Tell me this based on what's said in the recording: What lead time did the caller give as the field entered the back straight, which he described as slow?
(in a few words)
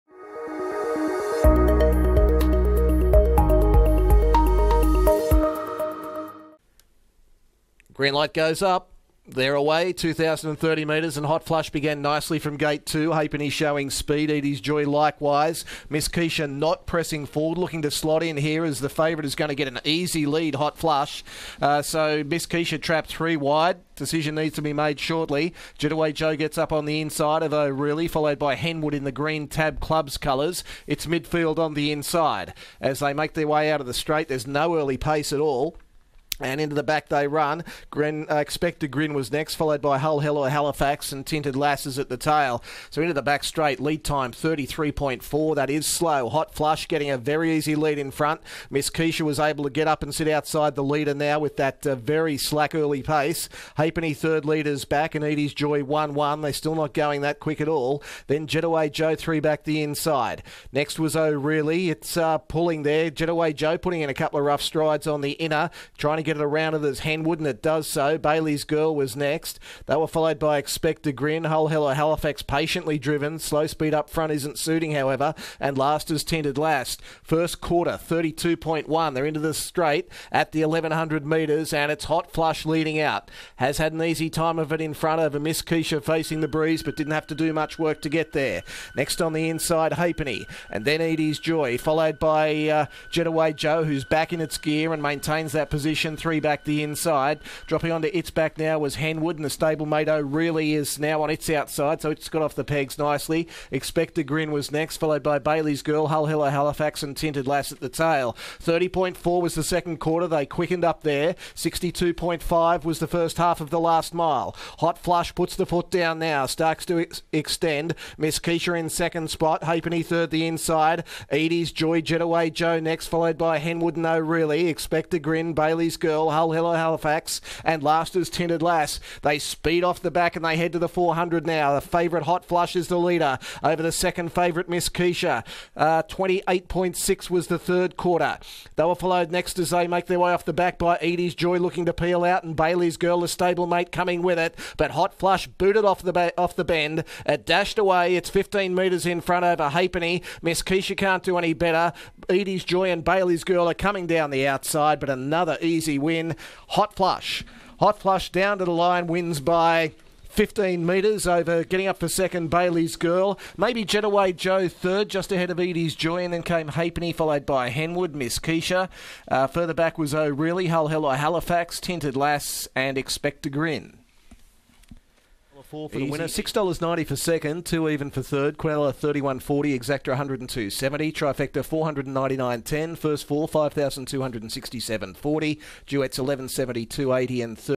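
33.4.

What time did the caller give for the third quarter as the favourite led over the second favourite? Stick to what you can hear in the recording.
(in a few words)
28.6.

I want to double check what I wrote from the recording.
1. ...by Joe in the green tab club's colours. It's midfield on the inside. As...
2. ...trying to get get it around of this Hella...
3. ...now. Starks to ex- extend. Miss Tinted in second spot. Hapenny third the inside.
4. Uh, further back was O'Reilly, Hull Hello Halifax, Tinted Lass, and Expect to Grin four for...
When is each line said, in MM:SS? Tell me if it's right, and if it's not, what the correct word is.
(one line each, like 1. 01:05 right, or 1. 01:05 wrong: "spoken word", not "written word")
1. 00:28 wrong: "Henwood", not "Joe"
2. 01:05 wrong: "Henwood", not "Hella"
3. 01:56 wrong: "Keisha", not "Tinted"
4. 02:49 right.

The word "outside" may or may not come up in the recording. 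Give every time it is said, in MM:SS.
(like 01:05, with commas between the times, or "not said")
00:50, 01:41, 02:34.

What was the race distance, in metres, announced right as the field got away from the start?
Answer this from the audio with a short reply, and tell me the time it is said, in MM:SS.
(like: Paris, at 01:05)
2030 metres, at 00:09.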